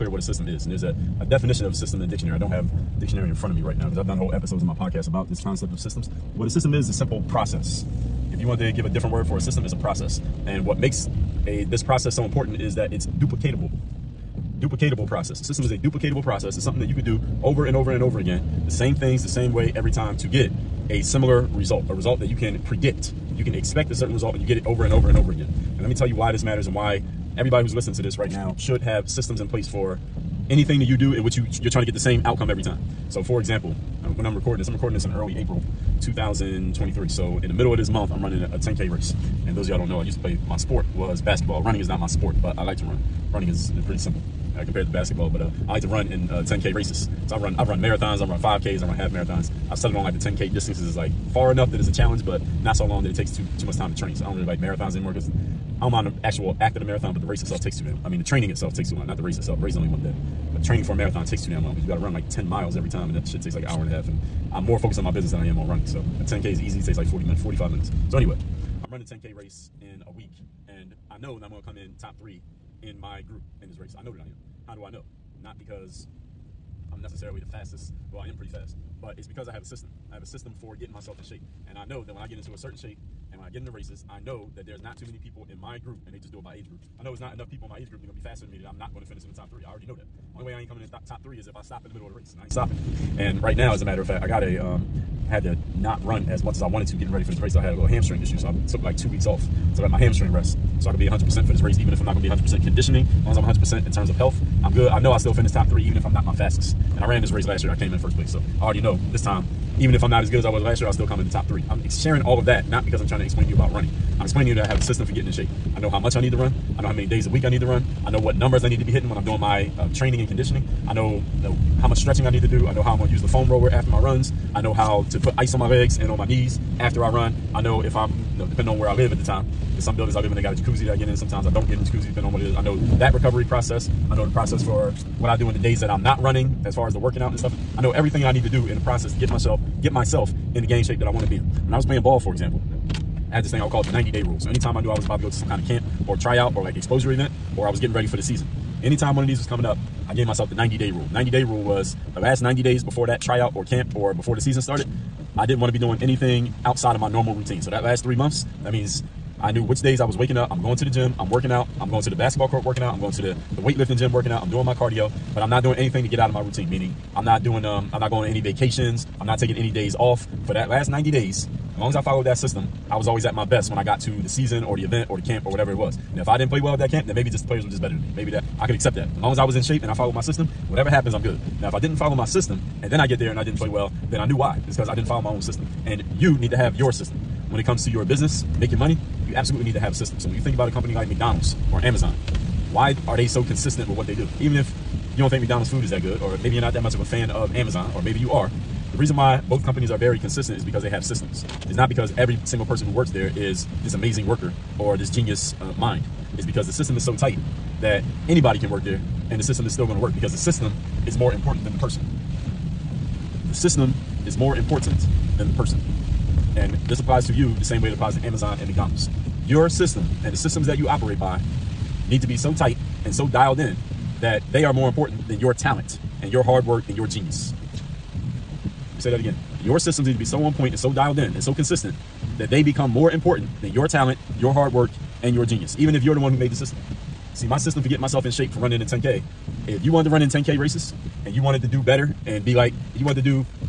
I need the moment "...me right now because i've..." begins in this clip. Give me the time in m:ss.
0:03.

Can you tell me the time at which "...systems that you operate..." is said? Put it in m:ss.
3:40.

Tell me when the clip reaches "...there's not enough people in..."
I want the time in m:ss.
1:27.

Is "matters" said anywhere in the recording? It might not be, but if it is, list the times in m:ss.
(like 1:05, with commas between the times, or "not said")
0:26, 1:33.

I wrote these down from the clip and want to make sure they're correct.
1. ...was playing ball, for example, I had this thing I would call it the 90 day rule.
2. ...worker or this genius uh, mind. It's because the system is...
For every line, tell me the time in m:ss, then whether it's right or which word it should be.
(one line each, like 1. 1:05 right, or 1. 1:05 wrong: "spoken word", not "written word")
1. 2:21 right
2. 3:24 right.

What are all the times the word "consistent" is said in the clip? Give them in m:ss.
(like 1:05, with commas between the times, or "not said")
3:13, 3:20, 3:51.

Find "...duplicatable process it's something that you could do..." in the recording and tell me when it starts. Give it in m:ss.
0:15.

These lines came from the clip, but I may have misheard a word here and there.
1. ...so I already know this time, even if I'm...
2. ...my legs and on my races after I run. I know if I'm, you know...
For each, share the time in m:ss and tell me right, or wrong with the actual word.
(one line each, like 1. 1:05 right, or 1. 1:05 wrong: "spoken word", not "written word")
1. 1:48 right
2. 2:05 wrong: "knees", not "races".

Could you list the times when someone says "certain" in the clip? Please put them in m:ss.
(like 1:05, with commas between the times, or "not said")
0:23, 1:22.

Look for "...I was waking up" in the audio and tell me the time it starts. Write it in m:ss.
2:39.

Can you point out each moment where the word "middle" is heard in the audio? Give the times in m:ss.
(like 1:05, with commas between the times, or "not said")
0:37, 1:31.